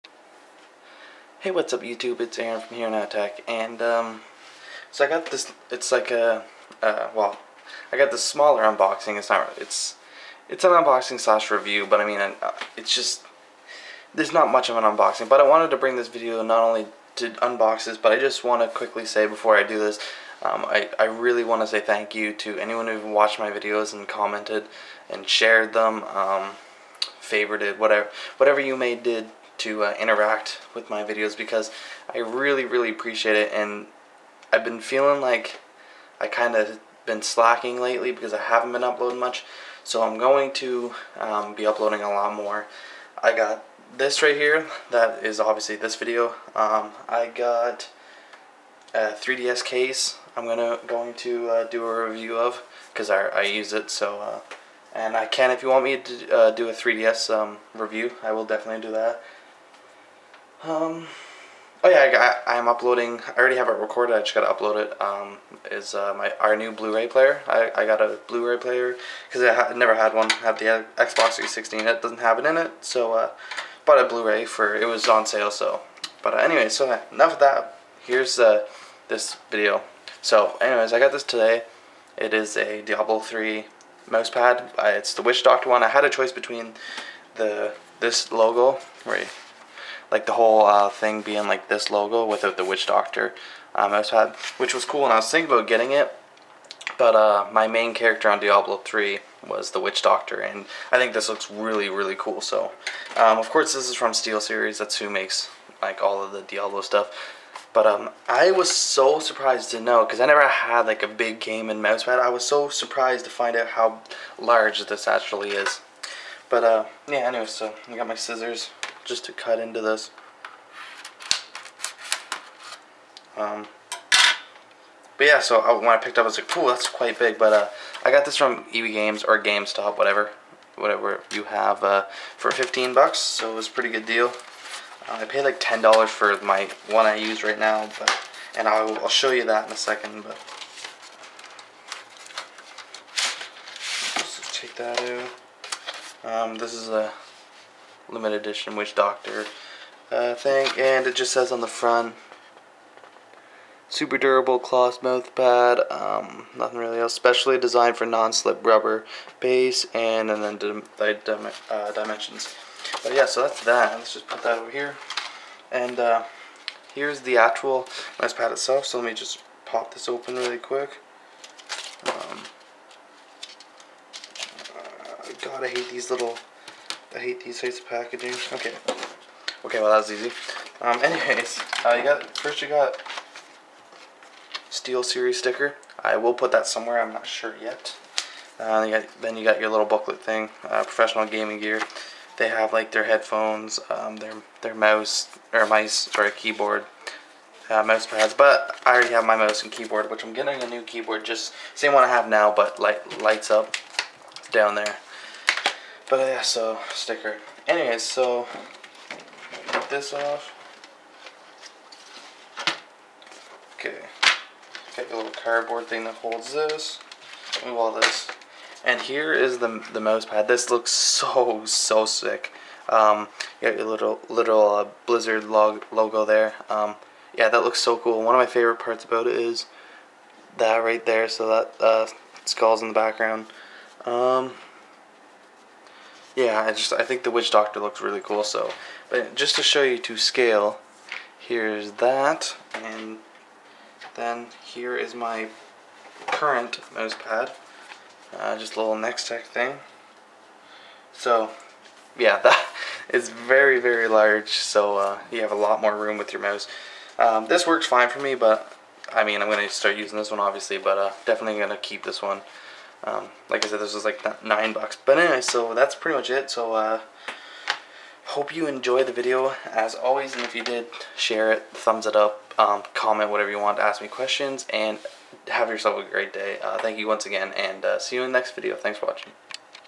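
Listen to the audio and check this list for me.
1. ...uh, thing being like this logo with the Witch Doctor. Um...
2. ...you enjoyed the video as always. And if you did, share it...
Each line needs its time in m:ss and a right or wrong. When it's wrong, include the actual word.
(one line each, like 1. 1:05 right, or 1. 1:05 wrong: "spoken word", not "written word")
1. 1:30 right
2. 4:28 right.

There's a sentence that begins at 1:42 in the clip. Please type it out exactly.
So, um, of course, this is from Steel Series.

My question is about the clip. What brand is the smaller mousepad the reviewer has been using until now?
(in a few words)
Nextech.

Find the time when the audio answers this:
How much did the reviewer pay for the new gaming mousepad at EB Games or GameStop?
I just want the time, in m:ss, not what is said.
2:12.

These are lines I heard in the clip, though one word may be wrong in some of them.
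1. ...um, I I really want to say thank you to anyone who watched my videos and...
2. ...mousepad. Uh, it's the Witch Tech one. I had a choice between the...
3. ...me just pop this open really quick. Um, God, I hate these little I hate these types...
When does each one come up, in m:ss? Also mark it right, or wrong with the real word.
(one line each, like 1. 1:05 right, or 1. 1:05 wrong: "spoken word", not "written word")
1. 0:20 right
2. 1:24 wrong: "Doctor", not "Tech"
3. 2:49 right.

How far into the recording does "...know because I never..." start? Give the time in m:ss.
1:49.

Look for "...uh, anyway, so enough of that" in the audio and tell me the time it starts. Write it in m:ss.
1:16.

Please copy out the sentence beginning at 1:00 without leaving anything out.
Um, oh yeah, I, I, am uploading.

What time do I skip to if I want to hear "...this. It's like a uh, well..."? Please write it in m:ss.
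0:05.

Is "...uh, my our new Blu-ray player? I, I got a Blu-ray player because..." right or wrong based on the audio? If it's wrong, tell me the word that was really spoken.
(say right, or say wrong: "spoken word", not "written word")
right.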